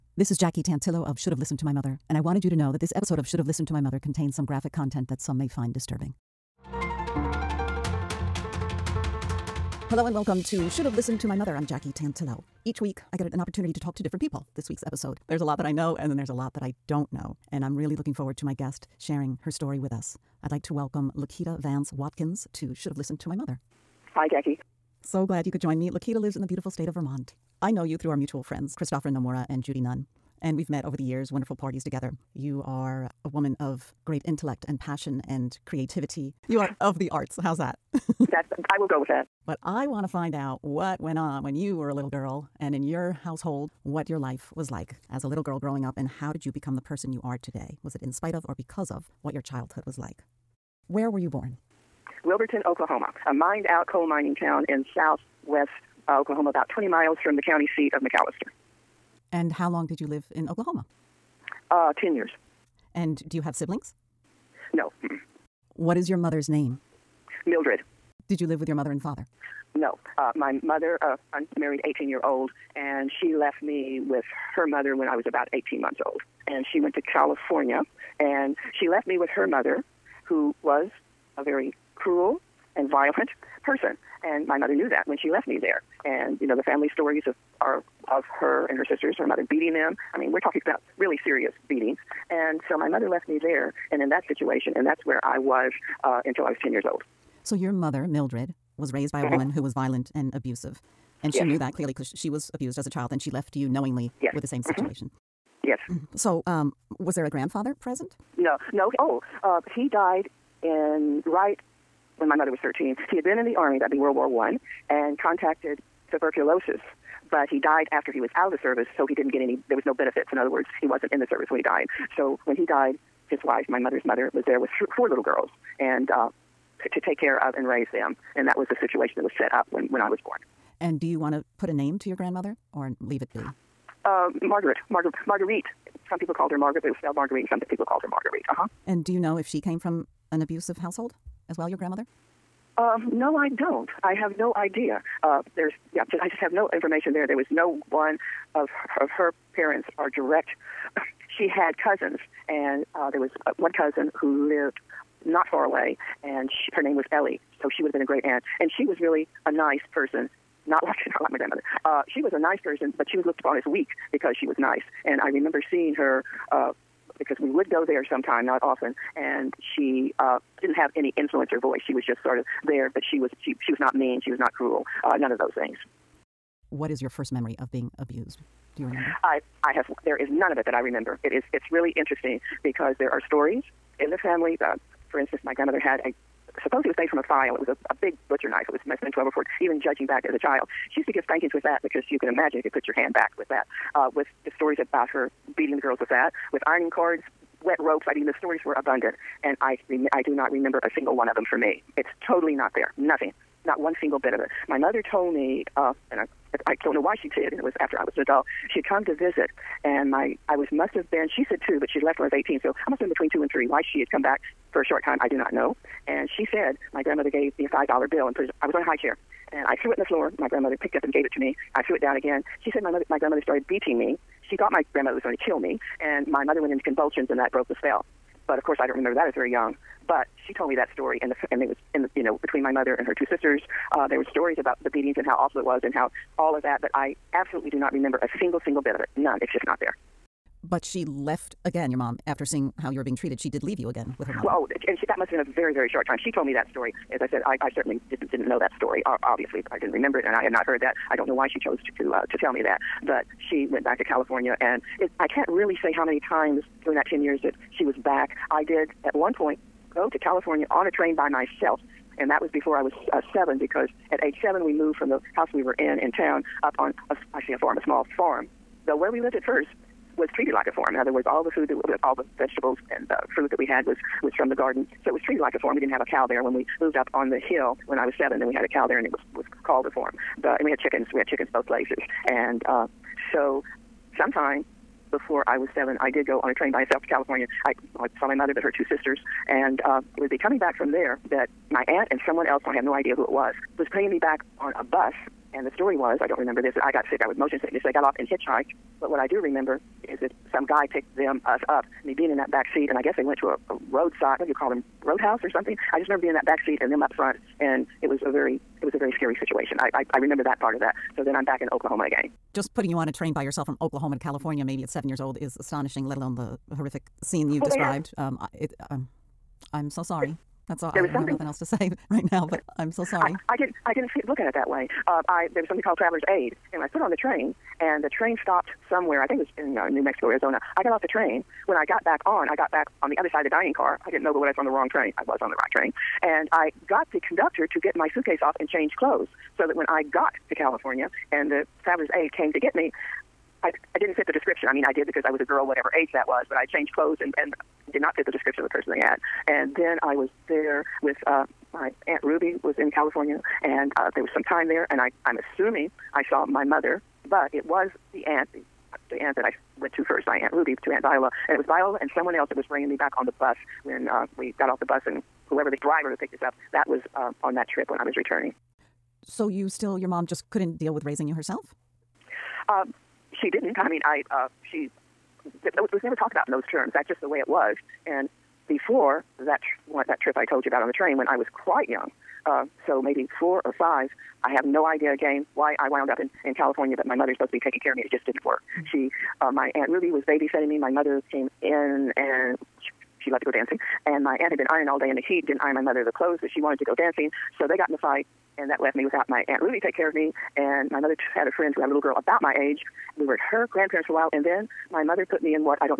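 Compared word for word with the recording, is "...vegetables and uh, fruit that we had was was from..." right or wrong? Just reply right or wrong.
right.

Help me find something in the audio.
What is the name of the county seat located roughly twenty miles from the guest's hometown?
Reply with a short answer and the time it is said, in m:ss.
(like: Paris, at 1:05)
McAlester, at 0:57.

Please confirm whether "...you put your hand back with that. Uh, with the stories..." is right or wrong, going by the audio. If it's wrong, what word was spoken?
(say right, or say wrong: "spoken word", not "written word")
right.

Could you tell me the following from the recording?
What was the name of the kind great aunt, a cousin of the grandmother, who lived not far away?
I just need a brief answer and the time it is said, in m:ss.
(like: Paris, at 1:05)
Ellie, at 2:37.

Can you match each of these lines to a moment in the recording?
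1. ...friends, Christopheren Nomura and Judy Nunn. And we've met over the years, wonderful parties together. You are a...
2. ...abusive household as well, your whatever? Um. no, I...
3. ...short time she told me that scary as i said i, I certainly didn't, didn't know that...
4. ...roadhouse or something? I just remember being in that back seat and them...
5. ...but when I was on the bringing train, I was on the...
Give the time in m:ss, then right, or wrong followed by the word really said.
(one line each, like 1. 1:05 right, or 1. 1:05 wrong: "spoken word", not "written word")
1. 0:28 right
2. 2:20 wrong: "grandmother", not "whatever"
3. 4:05 wrong: "story", not "scary"
4. 5:05 right
5. 5:34 wrong: "wrong", not "bringing".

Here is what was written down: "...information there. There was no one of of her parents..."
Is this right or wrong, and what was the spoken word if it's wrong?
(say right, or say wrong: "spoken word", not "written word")
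right.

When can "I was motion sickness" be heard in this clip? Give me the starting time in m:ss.
4:57.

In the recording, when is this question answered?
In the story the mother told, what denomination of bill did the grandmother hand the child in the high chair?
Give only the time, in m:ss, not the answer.
3:37.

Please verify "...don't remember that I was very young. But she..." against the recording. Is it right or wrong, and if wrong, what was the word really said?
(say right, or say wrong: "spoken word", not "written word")
right.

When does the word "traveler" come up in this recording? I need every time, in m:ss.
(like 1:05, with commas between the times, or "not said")
5:25, 5:41.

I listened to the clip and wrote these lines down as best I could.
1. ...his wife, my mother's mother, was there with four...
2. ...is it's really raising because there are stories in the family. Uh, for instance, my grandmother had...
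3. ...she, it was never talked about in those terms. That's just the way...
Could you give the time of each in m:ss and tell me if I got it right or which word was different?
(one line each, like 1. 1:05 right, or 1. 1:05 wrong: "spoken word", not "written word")
1. 2:03 right
2. 3:01 wrong: "interesting", not "raising"
3. 6:14 right.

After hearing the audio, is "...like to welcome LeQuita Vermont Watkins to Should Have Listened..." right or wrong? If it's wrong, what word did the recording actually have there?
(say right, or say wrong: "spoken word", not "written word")
wrong: "Vance", not "Vermont".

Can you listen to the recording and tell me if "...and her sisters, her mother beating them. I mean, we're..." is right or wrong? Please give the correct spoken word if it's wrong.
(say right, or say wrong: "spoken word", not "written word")
right.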